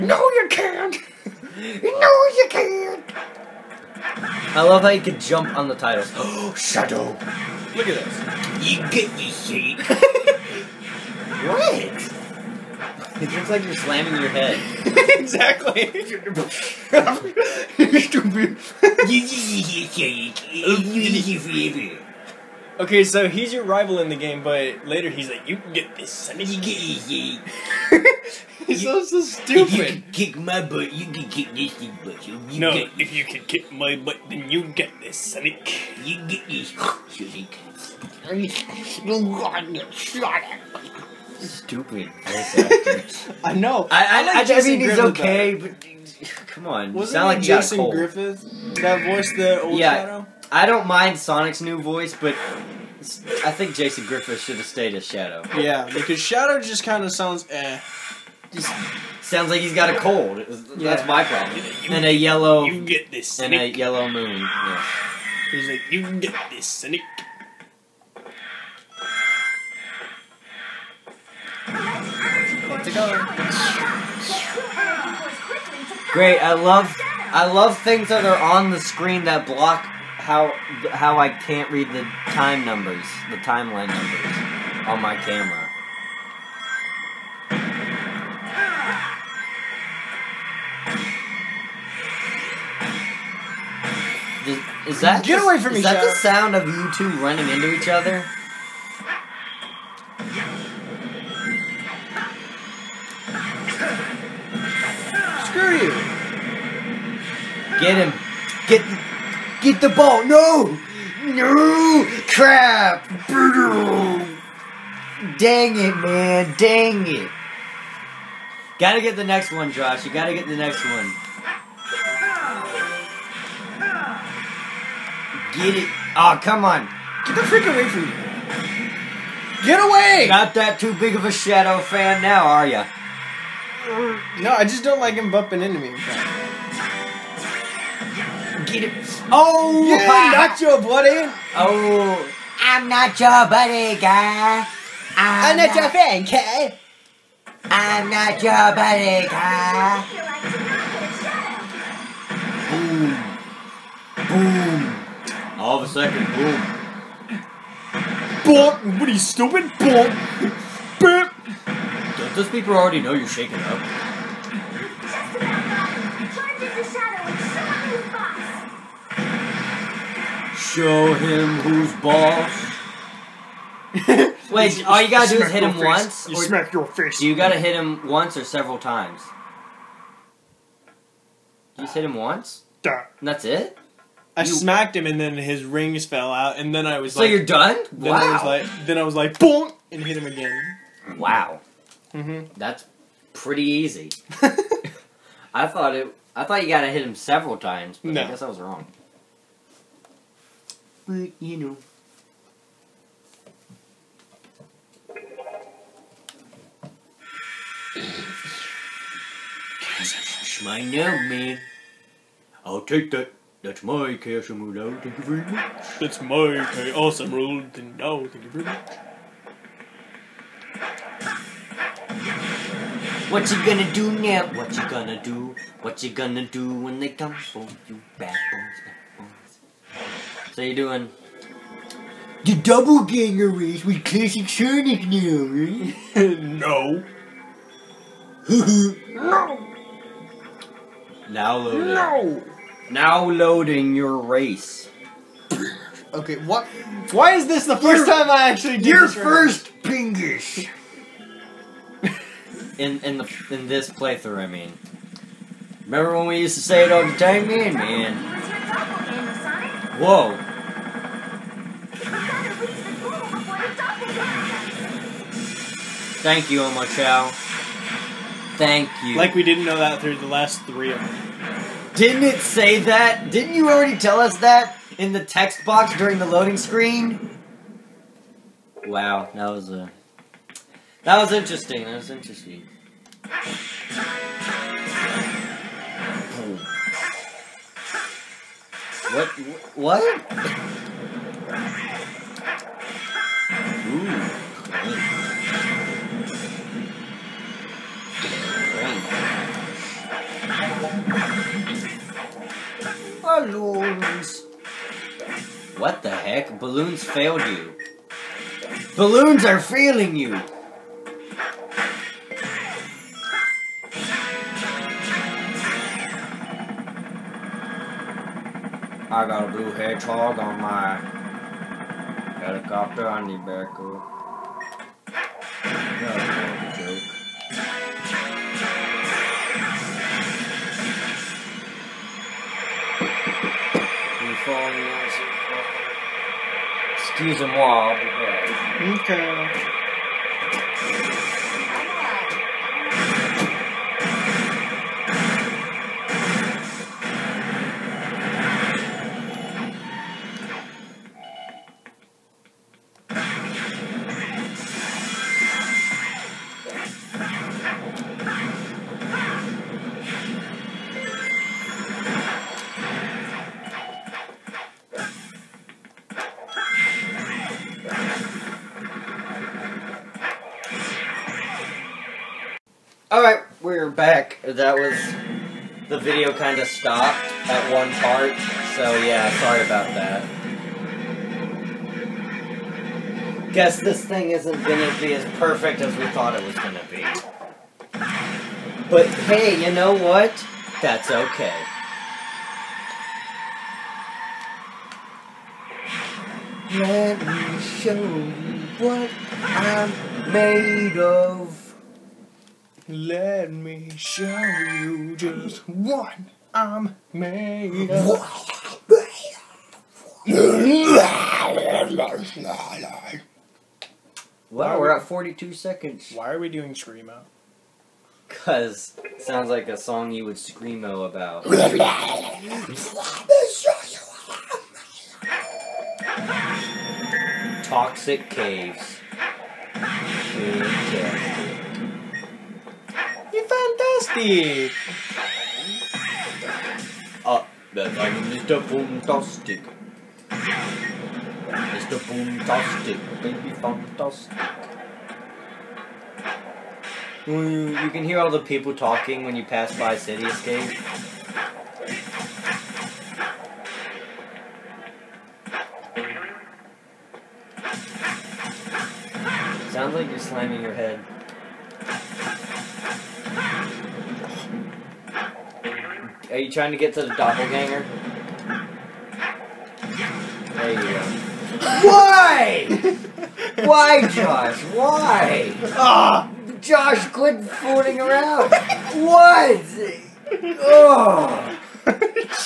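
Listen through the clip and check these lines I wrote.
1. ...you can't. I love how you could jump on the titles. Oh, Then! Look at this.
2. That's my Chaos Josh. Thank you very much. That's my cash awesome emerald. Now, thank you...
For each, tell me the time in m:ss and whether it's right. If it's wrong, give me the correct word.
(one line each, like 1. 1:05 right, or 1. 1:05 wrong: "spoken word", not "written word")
1. 0:02 wrong: "Shadow", not "Then"
2. 3:33 wrong: "Emerald", not "Josh".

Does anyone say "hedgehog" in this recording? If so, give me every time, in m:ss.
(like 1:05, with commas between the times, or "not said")
5:19.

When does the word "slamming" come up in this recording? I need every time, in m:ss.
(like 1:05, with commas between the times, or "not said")
0:13, 7:40.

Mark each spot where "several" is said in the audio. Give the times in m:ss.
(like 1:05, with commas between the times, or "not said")
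2:58, 3:17.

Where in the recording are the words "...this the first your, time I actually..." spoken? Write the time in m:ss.
4:07.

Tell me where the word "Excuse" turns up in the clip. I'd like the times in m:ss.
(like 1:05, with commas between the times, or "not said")
5:37.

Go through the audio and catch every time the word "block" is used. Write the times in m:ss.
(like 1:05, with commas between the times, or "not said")
1:19.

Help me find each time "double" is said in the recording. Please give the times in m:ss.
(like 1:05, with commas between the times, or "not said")
3:52.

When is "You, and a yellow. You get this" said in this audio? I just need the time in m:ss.
1:01.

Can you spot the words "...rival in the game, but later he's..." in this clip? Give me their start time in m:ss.
0:23.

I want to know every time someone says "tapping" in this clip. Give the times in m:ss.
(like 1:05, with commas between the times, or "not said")
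not said.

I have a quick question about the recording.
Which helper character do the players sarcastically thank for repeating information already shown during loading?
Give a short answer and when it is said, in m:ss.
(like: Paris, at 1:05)
Omochao, at 4:26.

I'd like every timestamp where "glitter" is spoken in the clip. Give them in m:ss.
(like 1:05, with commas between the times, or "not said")
not said.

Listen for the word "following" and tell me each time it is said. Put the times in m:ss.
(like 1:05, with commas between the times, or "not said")
5:34.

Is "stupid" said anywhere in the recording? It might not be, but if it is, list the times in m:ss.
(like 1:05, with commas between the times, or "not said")
0:18, 0:29, 0:41, 2:39.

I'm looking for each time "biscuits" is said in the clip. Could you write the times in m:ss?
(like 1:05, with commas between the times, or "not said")
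not said.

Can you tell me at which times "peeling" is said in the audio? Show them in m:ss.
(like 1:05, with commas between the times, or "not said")
not said.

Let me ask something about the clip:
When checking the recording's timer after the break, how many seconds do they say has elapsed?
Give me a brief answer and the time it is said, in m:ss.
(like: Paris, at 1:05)
42, at 6:55.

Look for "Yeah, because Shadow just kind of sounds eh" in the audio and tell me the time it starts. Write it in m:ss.
0:55.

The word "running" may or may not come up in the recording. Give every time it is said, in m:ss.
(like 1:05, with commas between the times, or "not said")
1:37.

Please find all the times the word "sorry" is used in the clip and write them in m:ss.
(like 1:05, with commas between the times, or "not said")
6:19.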